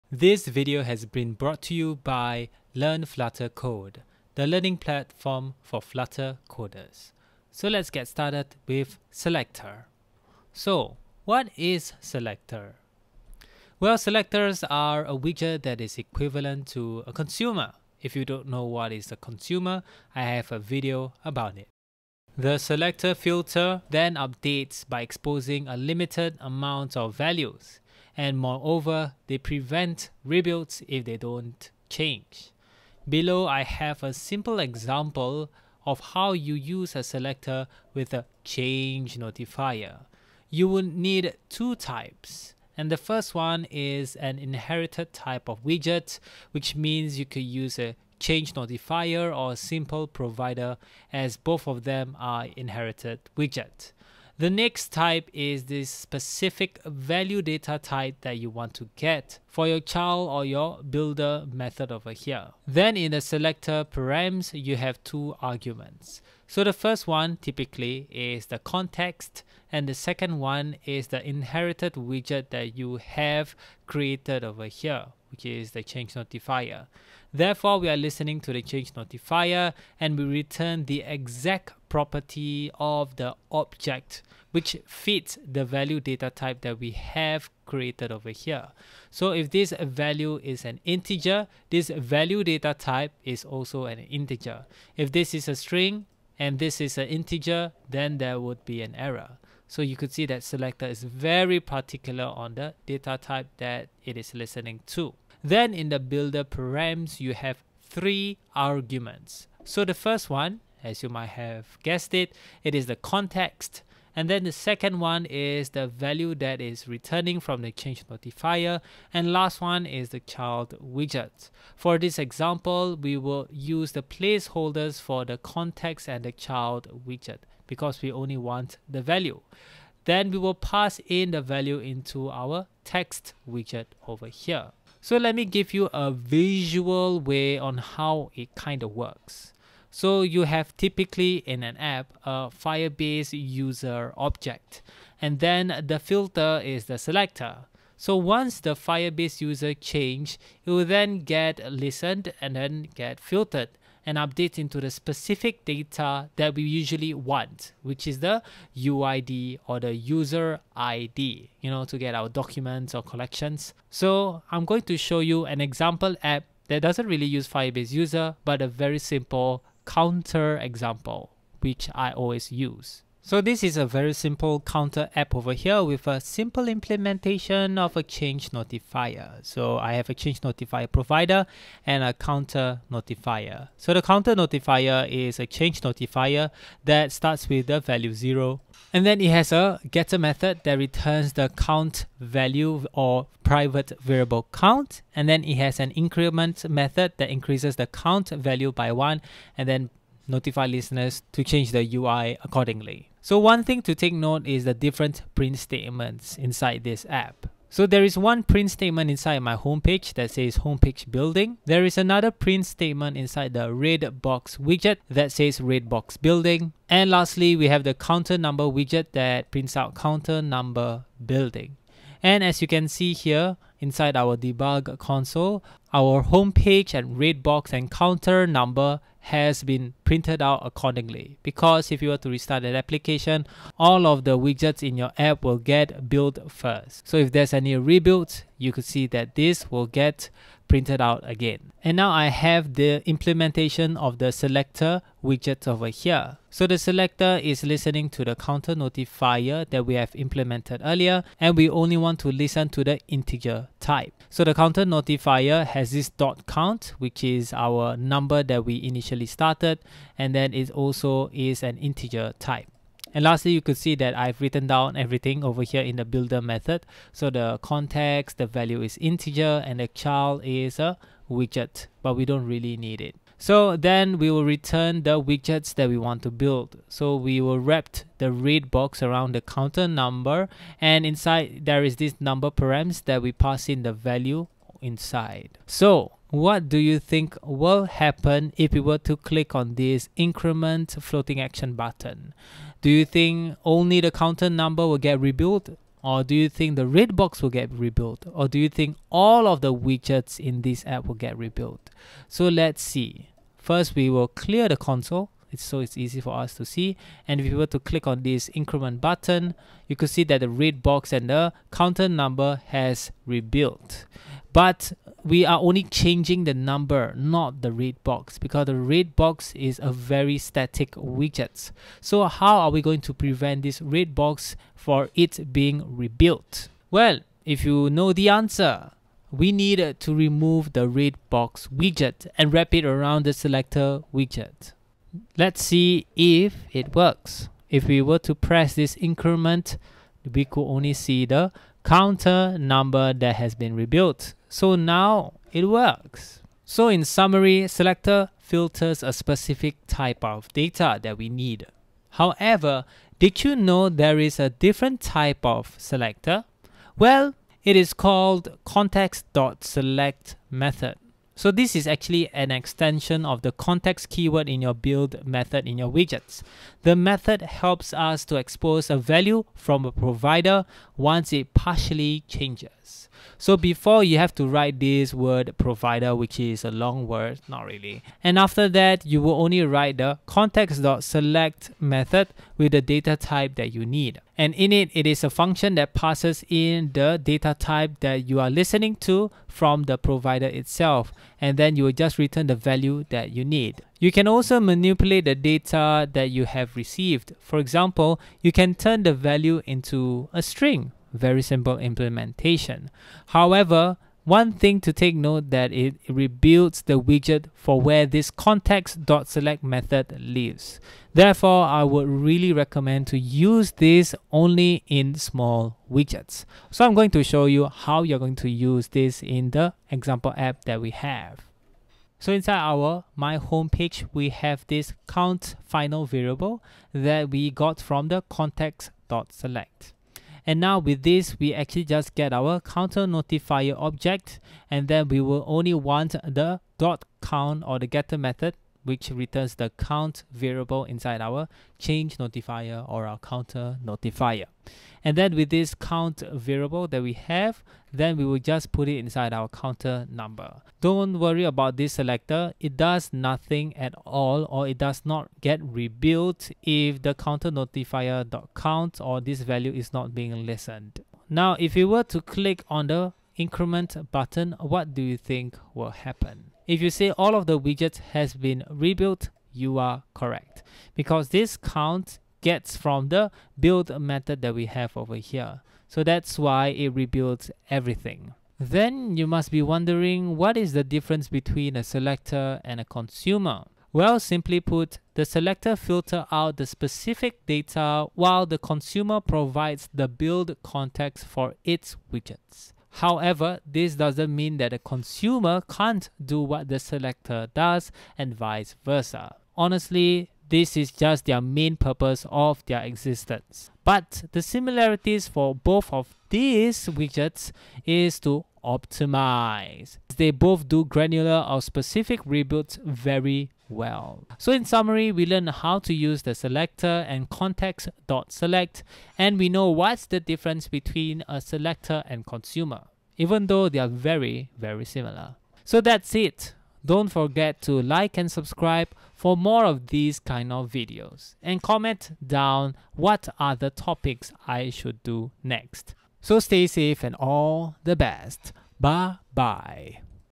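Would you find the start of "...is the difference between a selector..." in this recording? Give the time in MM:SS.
08:00.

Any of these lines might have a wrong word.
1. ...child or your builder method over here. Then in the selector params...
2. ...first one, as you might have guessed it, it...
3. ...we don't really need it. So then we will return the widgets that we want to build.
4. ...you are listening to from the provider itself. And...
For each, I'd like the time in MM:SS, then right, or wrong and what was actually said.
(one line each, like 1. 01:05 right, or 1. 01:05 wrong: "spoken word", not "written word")
1. 00:59 right
2. 01:49 right
3. 04:32 right
4. 06:28 right.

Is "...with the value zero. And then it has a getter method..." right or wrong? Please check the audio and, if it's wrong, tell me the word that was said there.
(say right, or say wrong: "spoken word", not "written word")
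right.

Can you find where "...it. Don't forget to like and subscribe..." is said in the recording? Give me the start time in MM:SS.
08:46.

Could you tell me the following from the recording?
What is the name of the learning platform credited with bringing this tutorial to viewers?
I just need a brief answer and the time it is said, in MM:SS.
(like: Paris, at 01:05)
Learn Flutter Code, at 00:02.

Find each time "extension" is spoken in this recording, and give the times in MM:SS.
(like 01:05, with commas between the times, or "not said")
06:02.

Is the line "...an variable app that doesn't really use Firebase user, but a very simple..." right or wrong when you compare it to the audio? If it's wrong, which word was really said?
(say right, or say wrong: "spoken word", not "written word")
wrong: "example", not "variable".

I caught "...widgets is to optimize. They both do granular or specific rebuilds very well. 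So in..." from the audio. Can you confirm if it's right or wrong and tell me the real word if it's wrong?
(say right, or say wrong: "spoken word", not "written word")
right.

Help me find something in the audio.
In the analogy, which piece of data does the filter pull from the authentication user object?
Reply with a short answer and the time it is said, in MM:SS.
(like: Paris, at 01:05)
UID, at 02:38.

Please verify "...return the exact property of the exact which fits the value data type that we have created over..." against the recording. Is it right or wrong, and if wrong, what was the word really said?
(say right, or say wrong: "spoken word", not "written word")
wrong: "object", not "exact".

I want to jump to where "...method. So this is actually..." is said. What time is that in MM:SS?
06:00.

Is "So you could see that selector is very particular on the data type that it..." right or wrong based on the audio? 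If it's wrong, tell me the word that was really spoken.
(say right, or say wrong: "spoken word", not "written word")
right.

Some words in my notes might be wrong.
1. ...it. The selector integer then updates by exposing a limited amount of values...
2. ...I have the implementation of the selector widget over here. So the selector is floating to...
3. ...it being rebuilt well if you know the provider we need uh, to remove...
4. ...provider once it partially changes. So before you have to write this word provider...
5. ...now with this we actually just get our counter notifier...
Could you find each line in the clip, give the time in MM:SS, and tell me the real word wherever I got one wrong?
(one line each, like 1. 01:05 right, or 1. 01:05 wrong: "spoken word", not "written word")
1. 00:21 wrong: "filter", not "integer"
2. 04:02 wrong: "listening", not "floating"
3. 05:25 wrong: "answer", not "provider"
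4. 06:09 right
5. 07:10 right.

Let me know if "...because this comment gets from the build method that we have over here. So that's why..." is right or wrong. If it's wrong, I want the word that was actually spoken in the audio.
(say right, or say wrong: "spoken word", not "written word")
wrong: "count", not "comment".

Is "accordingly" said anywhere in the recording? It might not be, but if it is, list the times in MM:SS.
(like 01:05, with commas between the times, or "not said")
03:22, 03:50.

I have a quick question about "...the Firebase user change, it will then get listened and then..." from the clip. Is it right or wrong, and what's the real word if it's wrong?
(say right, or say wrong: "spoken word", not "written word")
right.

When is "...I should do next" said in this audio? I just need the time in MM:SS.
08:54.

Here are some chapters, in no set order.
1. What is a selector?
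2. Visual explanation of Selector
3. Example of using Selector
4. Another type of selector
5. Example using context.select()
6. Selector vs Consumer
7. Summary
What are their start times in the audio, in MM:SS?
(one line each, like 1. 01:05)
1. 00:13
2. 02:19
3. 02:53
4. 05:57
5. 07:02
6. 08:03
7. 08:34.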